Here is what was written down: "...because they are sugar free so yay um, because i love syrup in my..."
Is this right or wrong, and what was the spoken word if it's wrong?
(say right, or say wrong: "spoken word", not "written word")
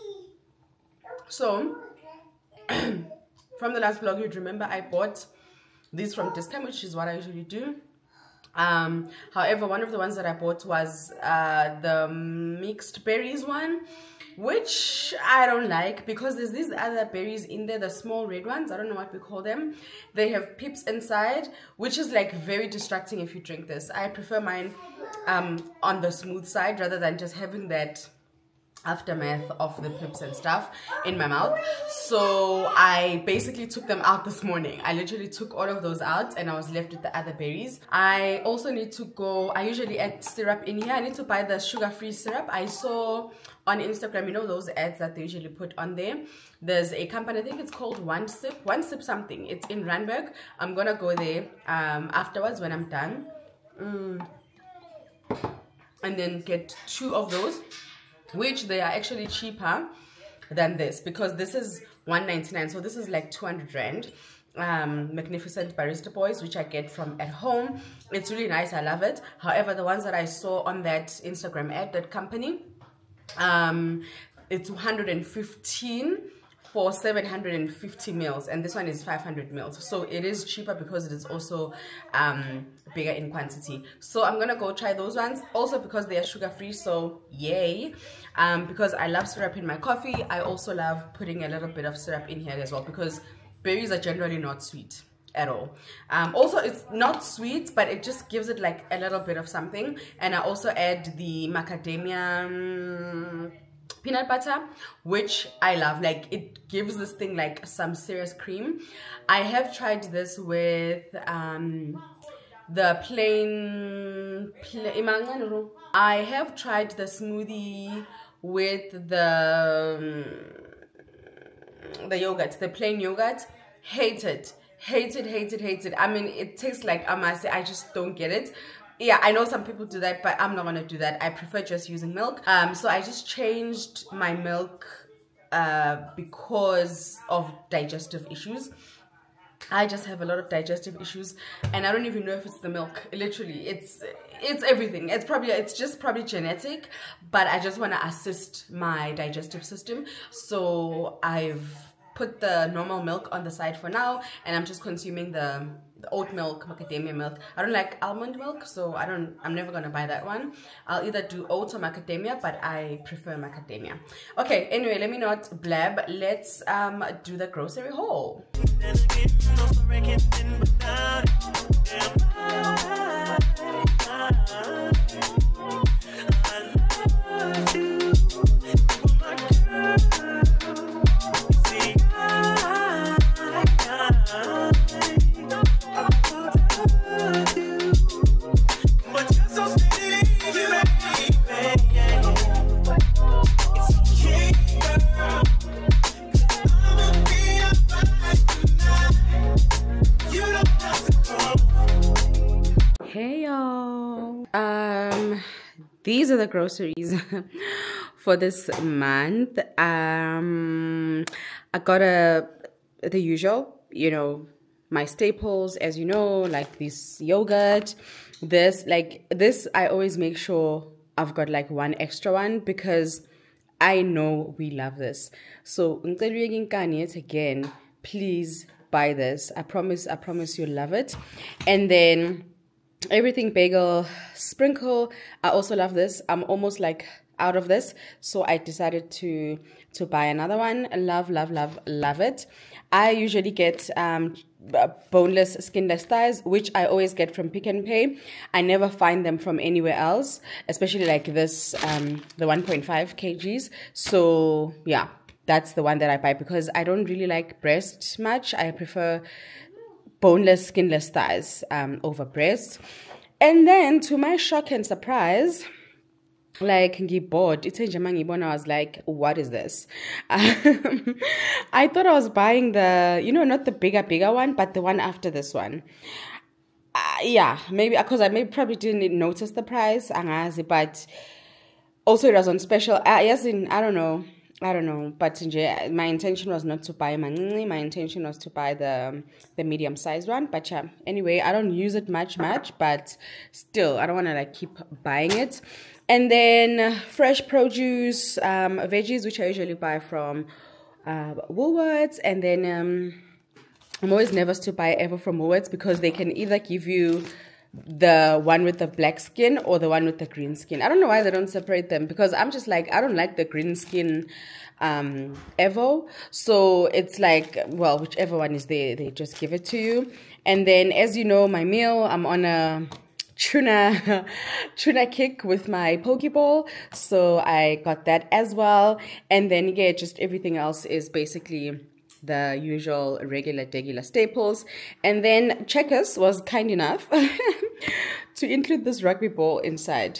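right.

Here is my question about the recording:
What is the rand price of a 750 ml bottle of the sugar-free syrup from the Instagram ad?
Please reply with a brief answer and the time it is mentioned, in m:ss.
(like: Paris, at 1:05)
115, at 1:14.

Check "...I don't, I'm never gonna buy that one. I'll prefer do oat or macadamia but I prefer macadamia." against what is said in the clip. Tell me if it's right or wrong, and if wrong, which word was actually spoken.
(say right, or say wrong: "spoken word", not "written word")
wrong: "either", not "prefer".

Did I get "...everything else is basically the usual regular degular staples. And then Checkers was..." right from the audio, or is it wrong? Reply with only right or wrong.
right.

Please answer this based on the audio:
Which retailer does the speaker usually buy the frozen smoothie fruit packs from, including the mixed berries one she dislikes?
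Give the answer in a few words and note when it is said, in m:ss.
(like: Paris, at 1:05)
Tesco, at 0:06.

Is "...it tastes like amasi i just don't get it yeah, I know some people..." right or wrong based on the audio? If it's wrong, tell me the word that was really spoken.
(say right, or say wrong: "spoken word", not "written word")
right.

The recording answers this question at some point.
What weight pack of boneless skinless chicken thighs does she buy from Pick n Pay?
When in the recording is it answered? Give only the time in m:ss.
4:12.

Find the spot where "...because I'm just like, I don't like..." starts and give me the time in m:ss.
5:12.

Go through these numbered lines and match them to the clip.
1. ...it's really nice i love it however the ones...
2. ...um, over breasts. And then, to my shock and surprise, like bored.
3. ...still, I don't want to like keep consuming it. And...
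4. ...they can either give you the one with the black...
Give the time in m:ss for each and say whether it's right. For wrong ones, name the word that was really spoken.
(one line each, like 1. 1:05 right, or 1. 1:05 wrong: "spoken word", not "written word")
1. 1:08 right
2. 4:21 right
3. 4:53 wrong: "buying", not "consuming"
4. 5:05 right.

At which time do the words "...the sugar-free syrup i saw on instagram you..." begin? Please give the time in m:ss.
0:41.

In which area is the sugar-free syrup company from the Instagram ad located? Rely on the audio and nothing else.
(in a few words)
Randburg.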